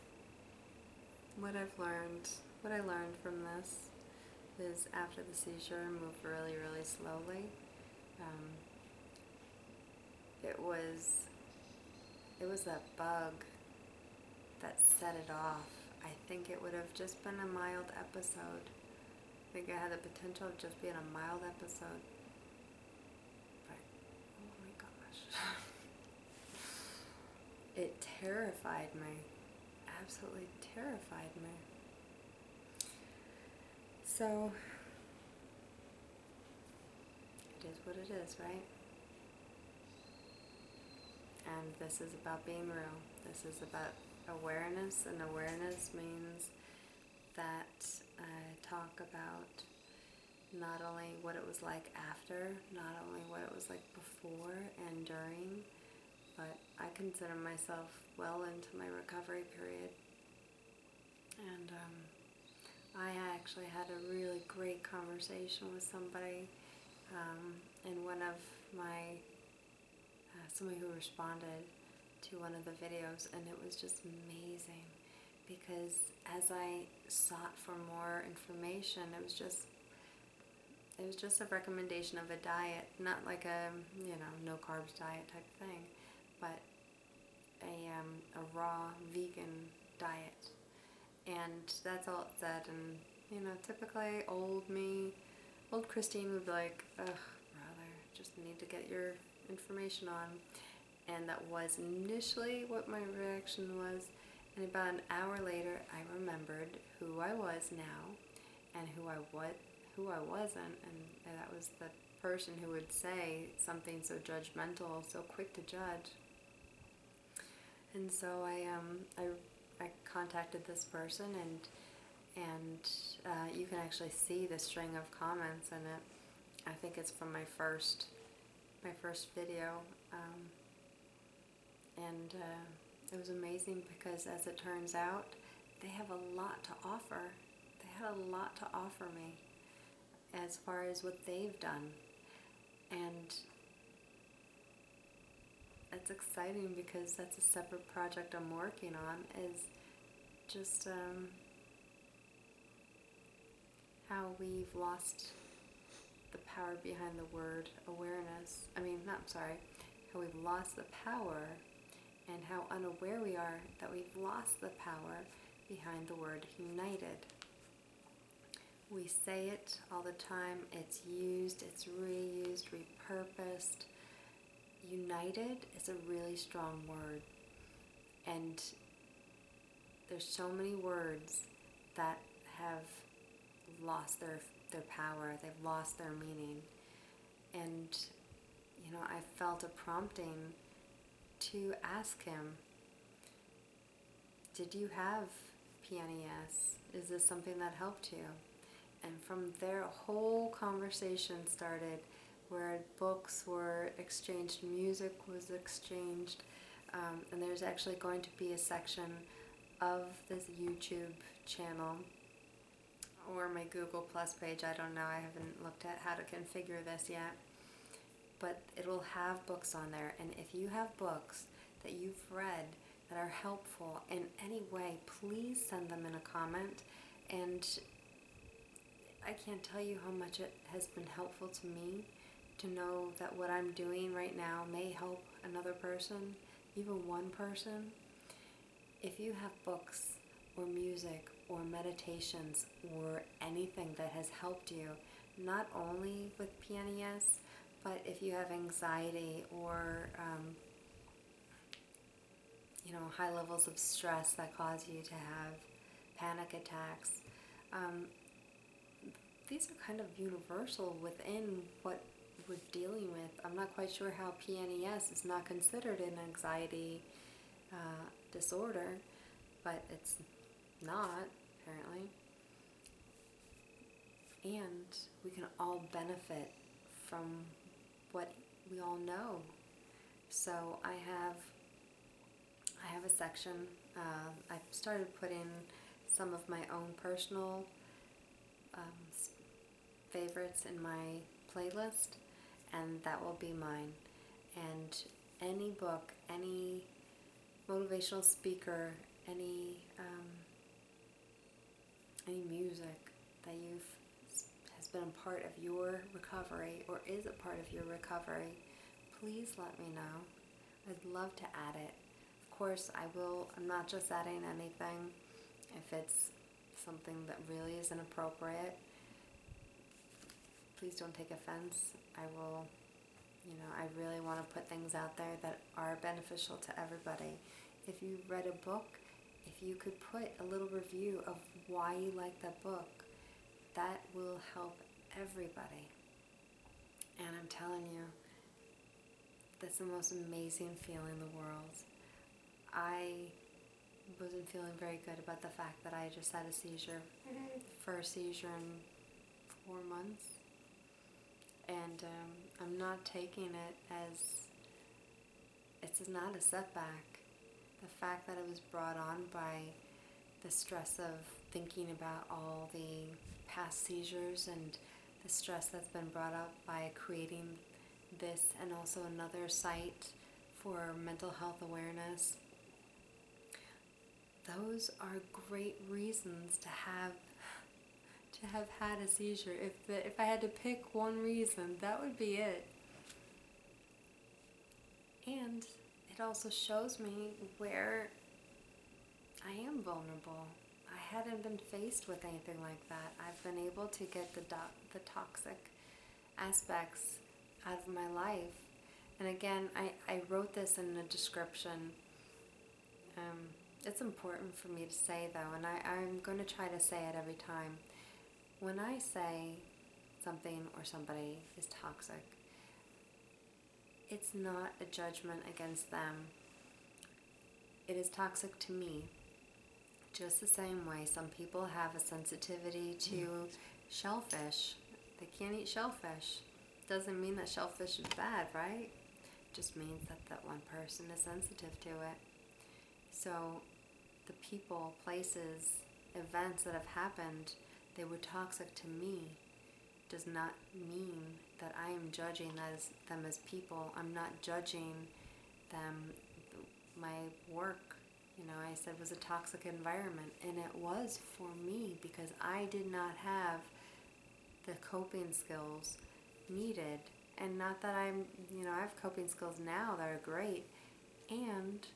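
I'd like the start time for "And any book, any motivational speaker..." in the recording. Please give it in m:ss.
4:54.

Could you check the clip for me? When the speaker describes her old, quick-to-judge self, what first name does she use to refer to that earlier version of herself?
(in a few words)
Christine.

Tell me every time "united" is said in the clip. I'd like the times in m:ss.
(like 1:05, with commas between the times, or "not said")
2:46, 2:54.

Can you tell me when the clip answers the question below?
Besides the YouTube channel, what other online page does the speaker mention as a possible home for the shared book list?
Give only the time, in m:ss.
3:33.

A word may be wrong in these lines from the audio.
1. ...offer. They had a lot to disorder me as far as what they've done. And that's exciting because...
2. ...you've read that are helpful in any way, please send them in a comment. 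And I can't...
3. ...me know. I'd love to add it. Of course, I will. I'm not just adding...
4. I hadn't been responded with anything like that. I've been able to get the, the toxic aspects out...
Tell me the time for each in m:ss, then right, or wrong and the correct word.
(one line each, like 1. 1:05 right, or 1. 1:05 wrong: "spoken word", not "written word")
1. 2:16 wrong: "offer", not "disorder"
2. 3:41 right
3. 5:09 right
4. 6:30 wrong: "faced", not "responded".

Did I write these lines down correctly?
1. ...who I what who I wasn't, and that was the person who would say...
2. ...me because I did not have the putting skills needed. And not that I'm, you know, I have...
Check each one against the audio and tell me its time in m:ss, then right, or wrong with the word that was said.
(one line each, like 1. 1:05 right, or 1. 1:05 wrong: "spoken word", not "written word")
1. 1:48 right
2. 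7:31 wrong: "coping", not "putting".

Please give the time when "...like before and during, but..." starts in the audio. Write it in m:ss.
0:53.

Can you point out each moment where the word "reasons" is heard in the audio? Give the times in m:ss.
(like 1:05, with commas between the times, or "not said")
6:15, 6:21.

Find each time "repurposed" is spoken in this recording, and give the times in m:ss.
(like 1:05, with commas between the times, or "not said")
2:52.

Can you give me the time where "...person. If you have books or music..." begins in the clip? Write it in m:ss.
3:57.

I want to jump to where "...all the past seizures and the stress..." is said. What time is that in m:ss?
6:02.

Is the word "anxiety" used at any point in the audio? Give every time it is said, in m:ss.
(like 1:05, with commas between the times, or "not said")
4:08, 4:26.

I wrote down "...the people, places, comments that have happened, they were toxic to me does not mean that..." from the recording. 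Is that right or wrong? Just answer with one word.
wrong.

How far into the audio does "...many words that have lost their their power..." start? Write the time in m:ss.
3:00.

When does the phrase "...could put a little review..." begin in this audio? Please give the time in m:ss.
5:29.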